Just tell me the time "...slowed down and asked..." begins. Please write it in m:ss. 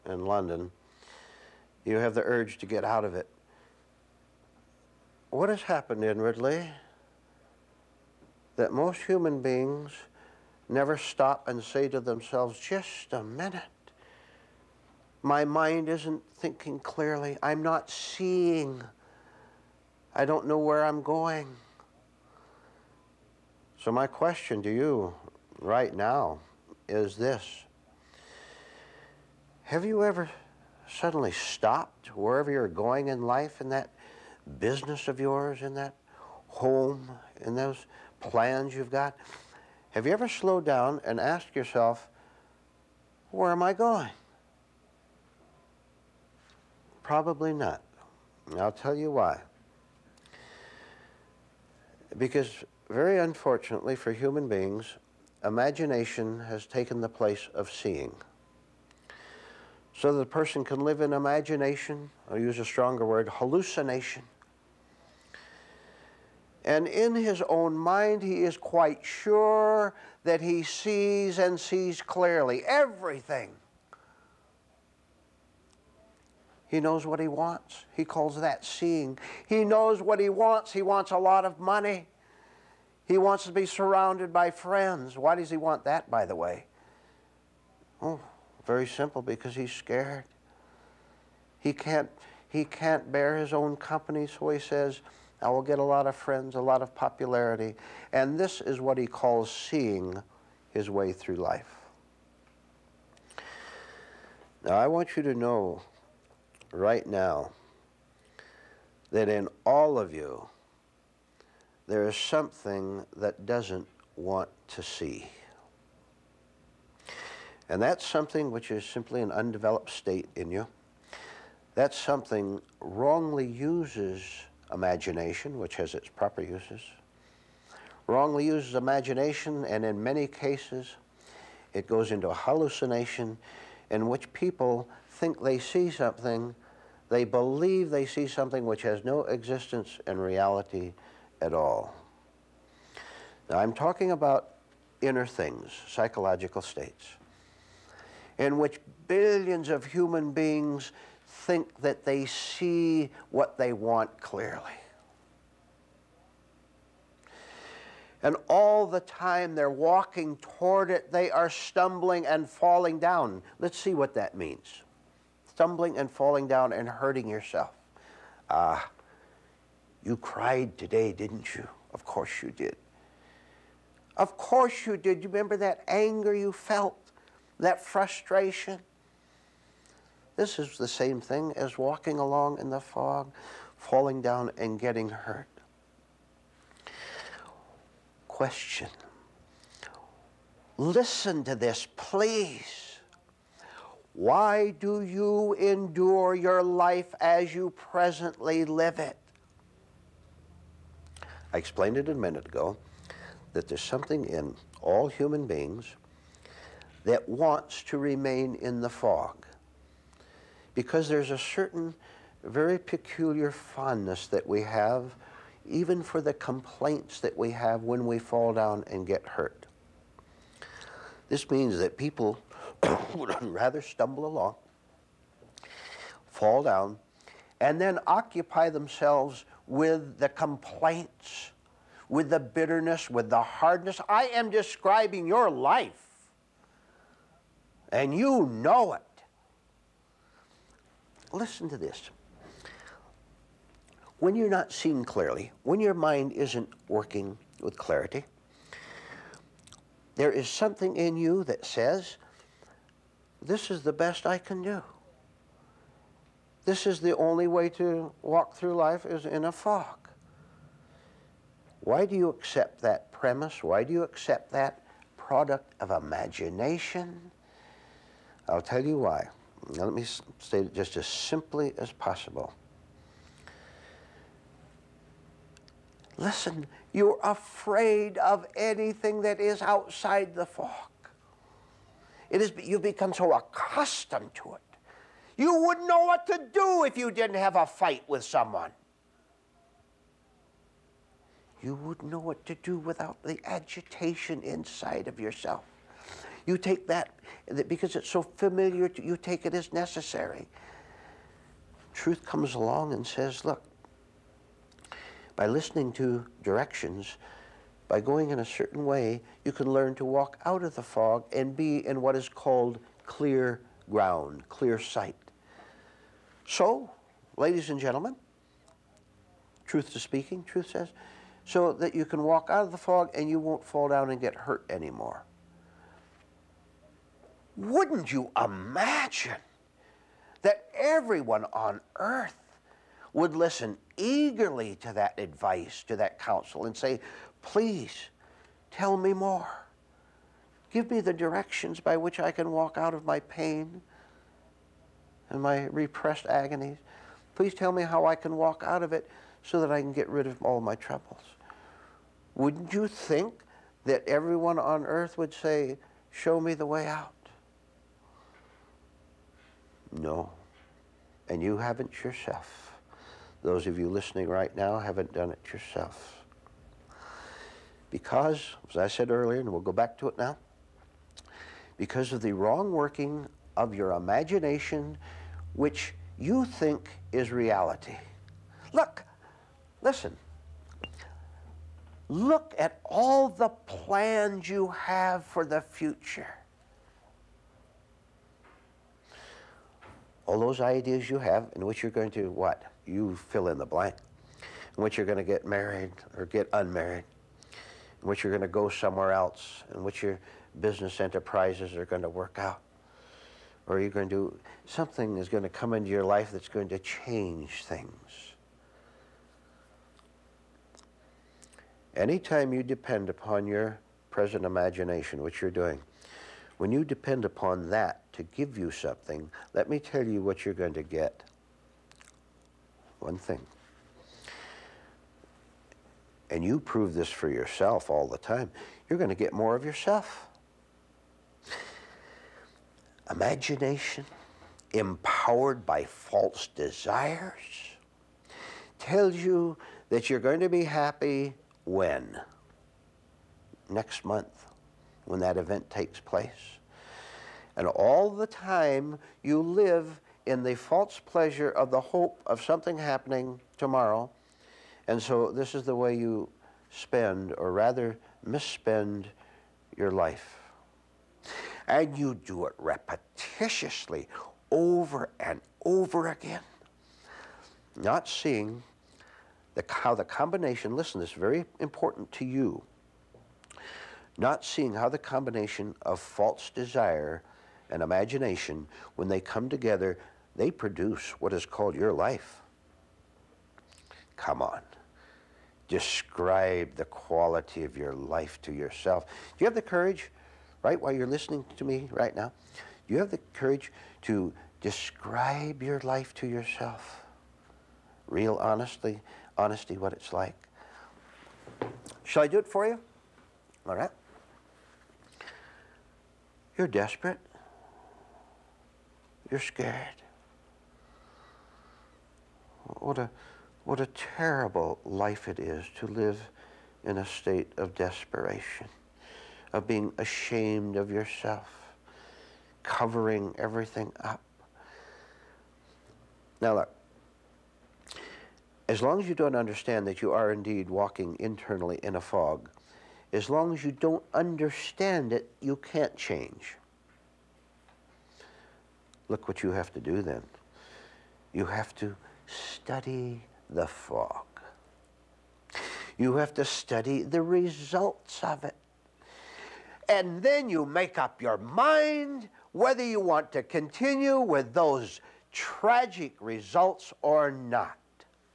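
0:40.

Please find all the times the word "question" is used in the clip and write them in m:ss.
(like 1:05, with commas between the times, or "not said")
0:24, 3:08.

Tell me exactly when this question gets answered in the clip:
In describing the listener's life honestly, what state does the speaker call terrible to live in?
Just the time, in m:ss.
8:37.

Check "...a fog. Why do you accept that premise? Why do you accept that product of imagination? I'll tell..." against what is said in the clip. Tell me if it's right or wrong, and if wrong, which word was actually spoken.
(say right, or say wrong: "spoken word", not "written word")
right.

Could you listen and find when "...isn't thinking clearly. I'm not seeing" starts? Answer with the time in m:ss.
0:15.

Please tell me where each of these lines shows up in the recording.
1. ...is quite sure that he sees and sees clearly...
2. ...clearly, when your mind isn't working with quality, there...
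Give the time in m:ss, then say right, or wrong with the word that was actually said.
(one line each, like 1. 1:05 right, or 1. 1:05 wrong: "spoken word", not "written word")
1. 1:08 right
2. 4:05 wrong: "clarity", not "quality".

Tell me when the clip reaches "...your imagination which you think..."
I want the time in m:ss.
6:13.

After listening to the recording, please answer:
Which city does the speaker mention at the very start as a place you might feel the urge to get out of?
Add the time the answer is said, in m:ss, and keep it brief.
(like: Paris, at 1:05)
London, at 0:00.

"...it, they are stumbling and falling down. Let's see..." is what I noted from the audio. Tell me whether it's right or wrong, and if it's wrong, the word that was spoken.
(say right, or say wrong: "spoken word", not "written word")
right.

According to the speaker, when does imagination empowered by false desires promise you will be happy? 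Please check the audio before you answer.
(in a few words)
Next month.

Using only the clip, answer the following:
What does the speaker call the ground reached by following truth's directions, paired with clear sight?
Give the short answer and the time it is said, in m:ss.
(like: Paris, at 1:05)
Clear ground, at 5:13.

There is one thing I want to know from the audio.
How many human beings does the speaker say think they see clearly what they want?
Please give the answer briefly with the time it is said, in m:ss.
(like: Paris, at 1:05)
Billions, at 2:29.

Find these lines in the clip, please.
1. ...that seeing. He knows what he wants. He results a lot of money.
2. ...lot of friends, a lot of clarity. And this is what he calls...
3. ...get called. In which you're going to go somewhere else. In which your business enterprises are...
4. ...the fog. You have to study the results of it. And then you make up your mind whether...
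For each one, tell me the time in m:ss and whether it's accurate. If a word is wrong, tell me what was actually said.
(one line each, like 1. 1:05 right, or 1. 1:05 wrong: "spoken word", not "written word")
1. 1:18 wrong: "wants", not "results"
2. 1:35 wrong: "popularity", not "clarity"
3. 6:36 wrong: "unmarried", not "called"
4. 9:03 right.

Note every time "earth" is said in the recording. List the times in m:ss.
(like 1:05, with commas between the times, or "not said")
5:31, 5:54.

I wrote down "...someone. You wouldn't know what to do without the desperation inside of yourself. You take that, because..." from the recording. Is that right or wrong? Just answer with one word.
wrong.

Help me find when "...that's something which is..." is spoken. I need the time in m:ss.
1:57.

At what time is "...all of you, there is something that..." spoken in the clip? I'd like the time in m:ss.
1:49.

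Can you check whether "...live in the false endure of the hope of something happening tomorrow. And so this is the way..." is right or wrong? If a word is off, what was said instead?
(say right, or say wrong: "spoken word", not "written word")
wrong: "pleasure", not "endure".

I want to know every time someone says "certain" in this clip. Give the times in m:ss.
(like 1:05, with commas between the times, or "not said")
3:31, 5:08.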